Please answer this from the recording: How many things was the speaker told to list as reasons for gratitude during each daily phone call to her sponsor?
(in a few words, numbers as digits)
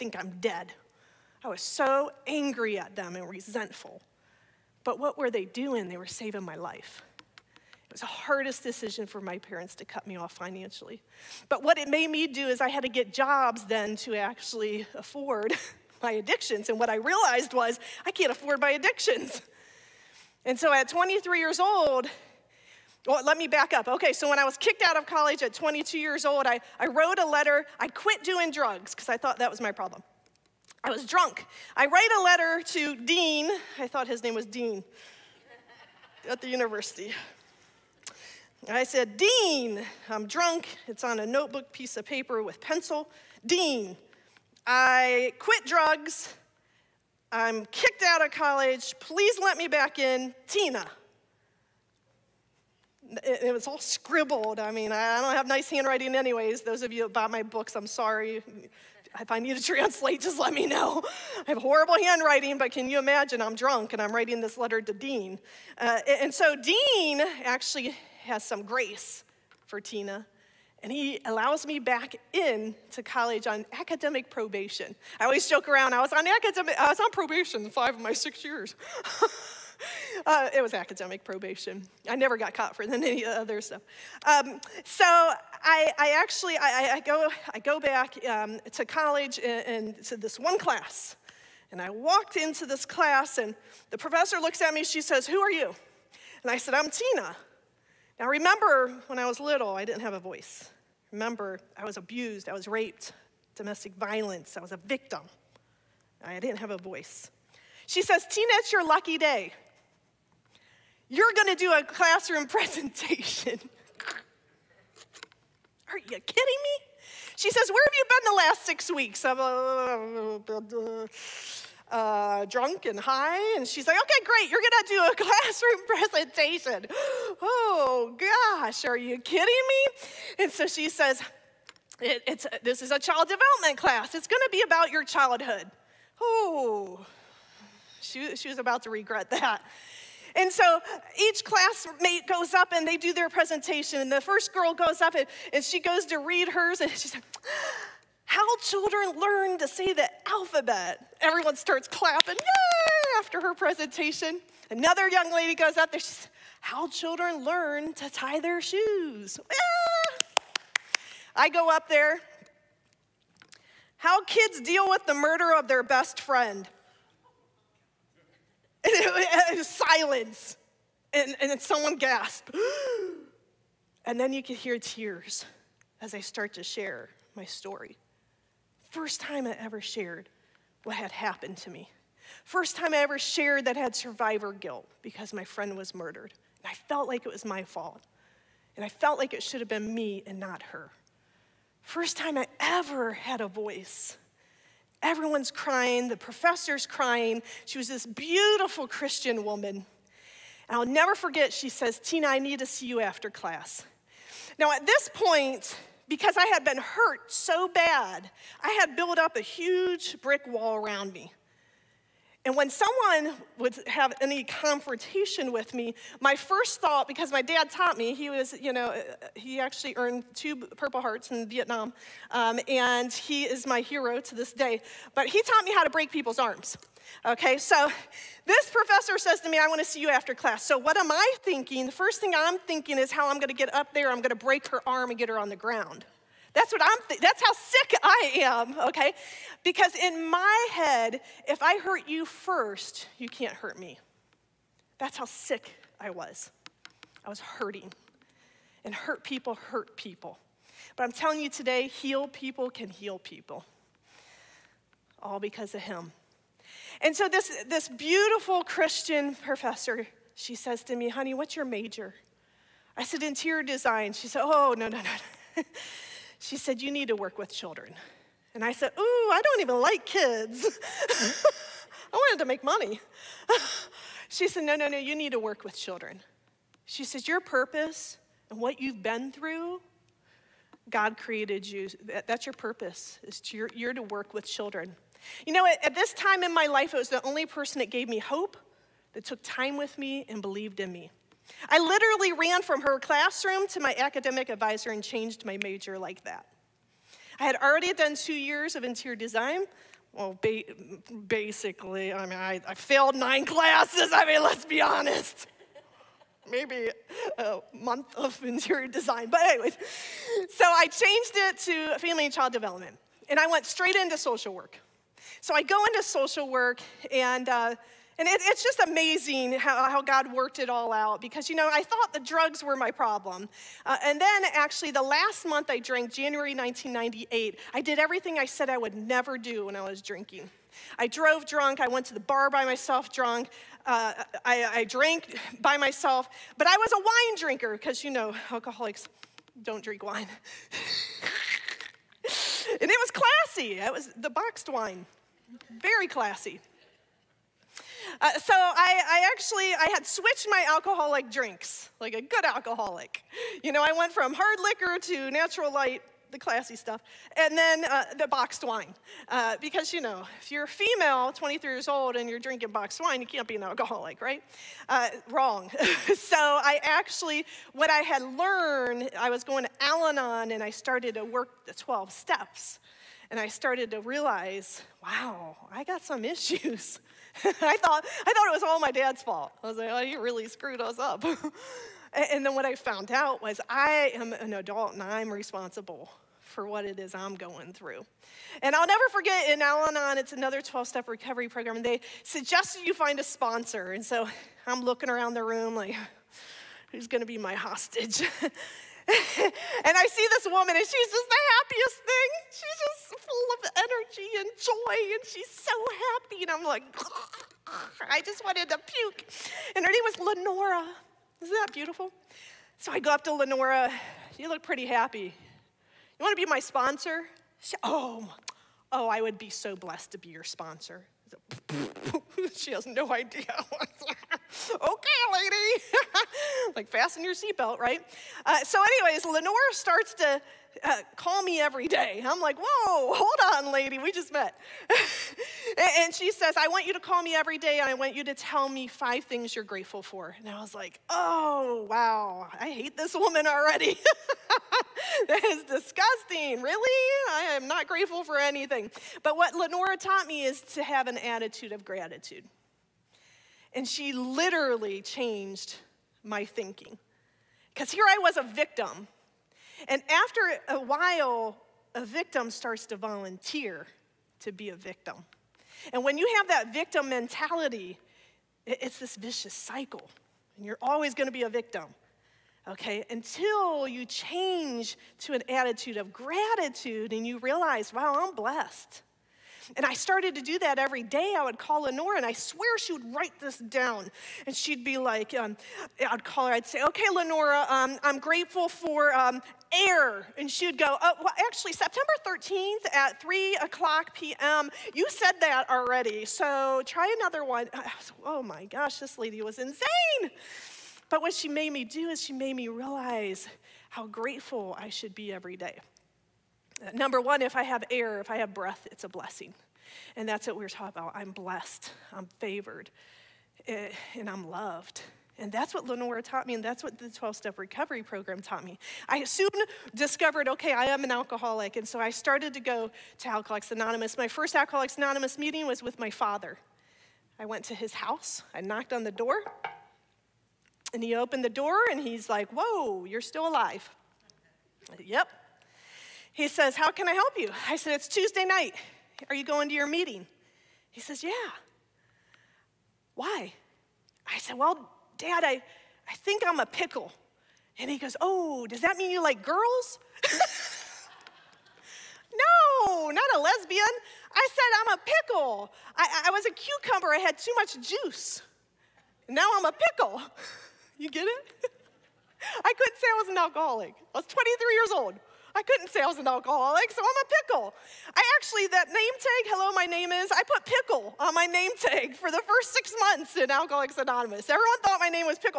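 5.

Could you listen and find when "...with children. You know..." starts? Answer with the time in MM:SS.
04:44.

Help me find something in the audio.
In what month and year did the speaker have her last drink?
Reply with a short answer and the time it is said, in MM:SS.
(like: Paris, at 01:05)
January 1998, at 05:26.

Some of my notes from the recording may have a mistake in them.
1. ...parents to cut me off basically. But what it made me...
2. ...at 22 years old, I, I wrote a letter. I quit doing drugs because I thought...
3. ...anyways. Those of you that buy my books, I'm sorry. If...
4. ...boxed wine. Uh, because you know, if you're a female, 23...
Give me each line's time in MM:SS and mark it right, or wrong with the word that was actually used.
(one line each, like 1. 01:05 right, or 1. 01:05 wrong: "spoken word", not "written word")
1. 00:09 wrong: "financially", not "basically"
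2. 00:25 right
3. 00:56 right
4. 05:58 right.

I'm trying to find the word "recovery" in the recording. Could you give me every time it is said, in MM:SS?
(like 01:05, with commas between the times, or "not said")
06:31, 08:37.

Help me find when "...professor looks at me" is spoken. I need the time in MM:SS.
01:33.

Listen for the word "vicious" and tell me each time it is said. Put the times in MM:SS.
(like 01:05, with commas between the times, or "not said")
07:49.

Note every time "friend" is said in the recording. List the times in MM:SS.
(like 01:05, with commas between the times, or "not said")
02:46, 03:05.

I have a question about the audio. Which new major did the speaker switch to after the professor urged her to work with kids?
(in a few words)
Family and child development.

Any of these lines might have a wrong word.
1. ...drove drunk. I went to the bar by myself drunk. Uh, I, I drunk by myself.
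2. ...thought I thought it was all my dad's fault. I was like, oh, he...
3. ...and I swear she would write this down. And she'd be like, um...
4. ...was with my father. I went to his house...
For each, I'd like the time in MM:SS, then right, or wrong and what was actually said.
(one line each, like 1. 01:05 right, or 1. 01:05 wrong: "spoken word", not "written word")
1. 05:31 wrong: "drank", not "drunk"
2. 06:17 right
3. 08:02 right
4. 08:45 right.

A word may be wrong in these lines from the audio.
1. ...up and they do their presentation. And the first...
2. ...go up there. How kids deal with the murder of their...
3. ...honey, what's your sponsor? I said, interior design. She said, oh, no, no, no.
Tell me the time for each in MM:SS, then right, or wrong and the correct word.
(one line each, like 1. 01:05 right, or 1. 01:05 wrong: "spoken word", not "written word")
1. 02:22 right
2. 02:41 right
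3. 04:21 wrong: "major", not "sponsor".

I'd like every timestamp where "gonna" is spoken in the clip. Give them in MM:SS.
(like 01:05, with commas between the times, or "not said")
01:51, 02:04, 02:14, 06:37.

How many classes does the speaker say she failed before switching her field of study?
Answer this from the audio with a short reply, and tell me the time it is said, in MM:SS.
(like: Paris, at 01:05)
9, at 05:03.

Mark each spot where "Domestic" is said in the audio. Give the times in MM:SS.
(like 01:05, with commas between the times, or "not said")
01:43.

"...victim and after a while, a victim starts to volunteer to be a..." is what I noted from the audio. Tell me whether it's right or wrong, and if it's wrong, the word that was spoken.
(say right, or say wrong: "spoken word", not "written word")
right.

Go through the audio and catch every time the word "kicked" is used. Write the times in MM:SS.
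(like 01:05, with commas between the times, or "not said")
00:24, 00:47.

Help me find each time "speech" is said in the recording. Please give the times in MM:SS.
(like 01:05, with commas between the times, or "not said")
not said.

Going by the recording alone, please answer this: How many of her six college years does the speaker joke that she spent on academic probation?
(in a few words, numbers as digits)
5.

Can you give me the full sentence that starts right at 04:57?
I had already done two years of interior design.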